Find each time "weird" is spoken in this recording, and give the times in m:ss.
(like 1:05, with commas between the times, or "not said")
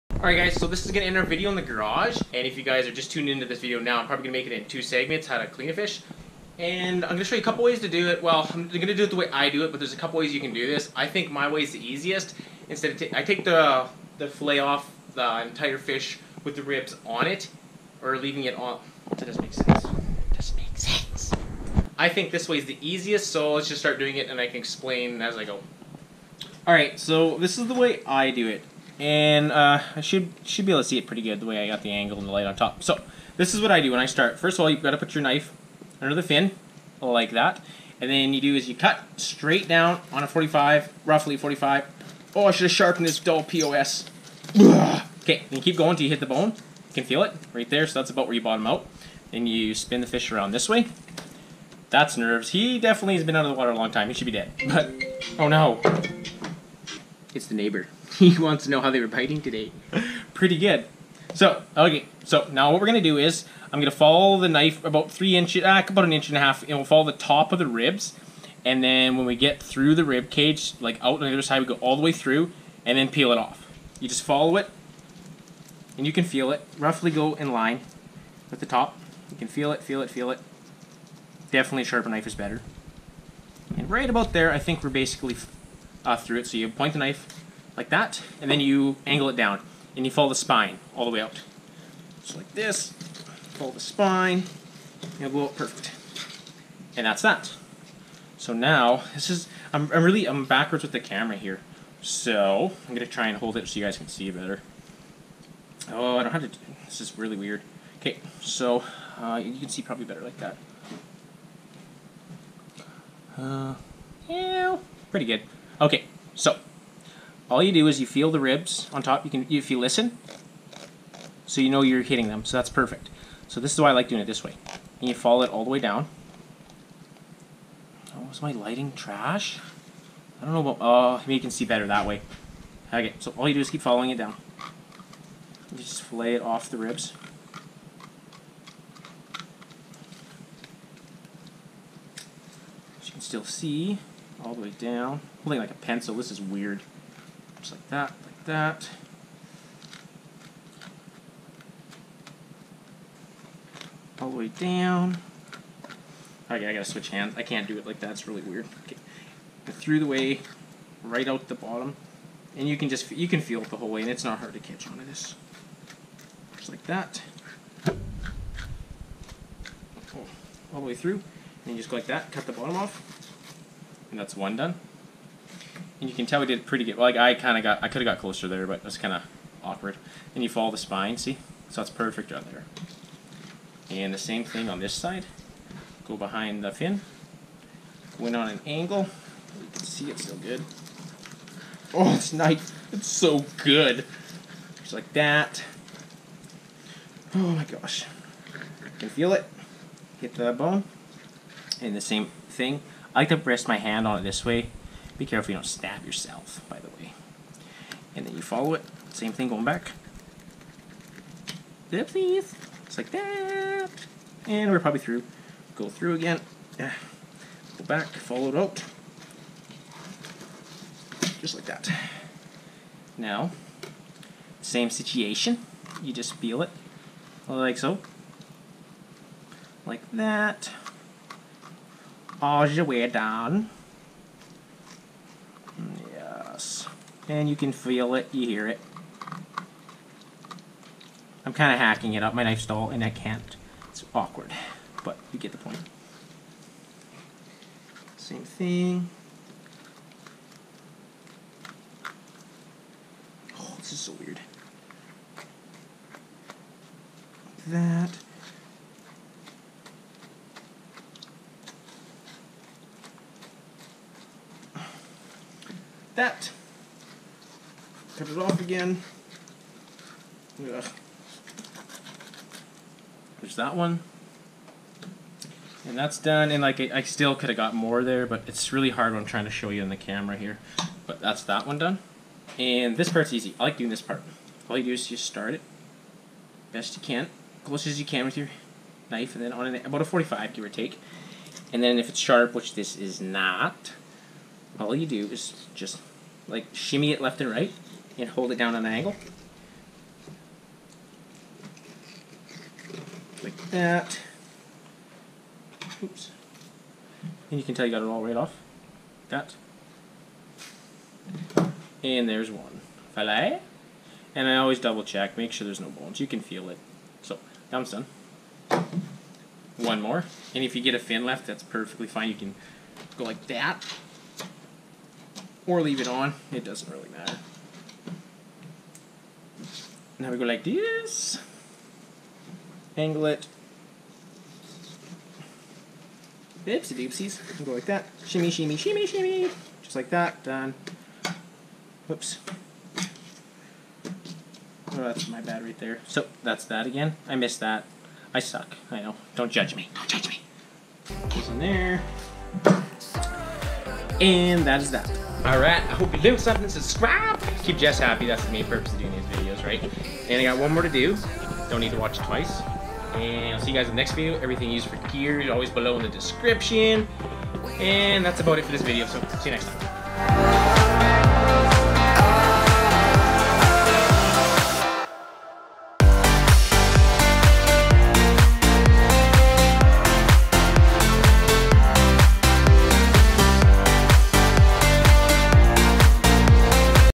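1:47, 2:26, 2:38, 4:14.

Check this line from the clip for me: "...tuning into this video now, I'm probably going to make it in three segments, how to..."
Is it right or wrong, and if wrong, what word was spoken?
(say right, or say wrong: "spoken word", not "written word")
wrong: "two", not "three".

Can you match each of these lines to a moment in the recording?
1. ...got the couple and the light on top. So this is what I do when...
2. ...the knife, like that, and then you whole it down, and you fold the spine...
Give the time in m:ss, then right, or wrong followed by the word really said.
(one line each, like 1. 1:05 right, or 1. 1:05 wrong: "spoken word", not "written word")
1. 0:31 wrong: "angle", not "couple"
2. 1:26 wrong: "angle", not "whole".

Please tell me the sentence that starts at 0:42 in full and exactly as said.
Oh, I should have sharpened this dull POS.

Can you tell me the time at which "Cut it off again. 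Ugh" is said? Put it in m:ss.
4:28.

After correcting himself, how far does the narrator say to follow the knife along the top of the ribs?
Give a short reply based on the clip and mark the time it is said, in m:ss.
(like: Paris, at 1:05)
An inch and a half, at 1:06.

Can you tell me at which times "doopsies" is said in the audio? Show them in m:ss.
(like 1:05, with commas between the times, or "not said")
5:36.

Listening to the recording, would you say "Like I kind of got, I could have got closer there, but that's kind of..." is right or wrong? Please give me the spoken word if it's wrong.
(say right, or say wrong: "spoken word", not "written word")
right.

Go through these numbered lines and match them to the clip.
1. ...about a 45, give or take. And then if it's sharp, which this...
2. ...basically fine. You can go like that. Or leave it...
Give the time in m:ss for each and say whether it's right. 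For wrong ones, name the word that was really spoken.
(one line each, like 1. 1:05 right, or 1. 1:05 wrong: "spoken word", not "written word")
1. 4:49 right
2. 5:21 wrong: "perfectly", not "basically".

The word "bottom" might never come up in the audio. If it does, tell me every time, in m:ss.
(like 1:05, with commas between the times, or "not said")
0:48, 2:41, 2:52.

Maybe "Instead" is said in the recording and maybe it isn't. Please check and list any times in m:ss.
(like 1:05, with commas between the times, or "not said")
0:12.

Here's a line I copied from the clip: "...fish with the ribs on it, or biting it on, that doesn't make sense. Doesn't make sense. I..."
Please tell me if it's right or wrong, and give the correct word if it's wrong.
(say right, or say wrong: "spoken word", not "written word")
wrong: "leaving", not "biting".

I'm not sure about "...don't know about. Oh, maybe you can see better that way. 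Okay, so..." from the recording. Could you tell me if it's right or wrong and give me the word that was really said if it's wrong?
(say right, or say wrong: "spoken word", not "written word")
right.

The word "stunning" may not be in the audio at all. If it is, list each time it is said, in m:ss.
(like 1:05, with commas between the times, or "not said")
not said.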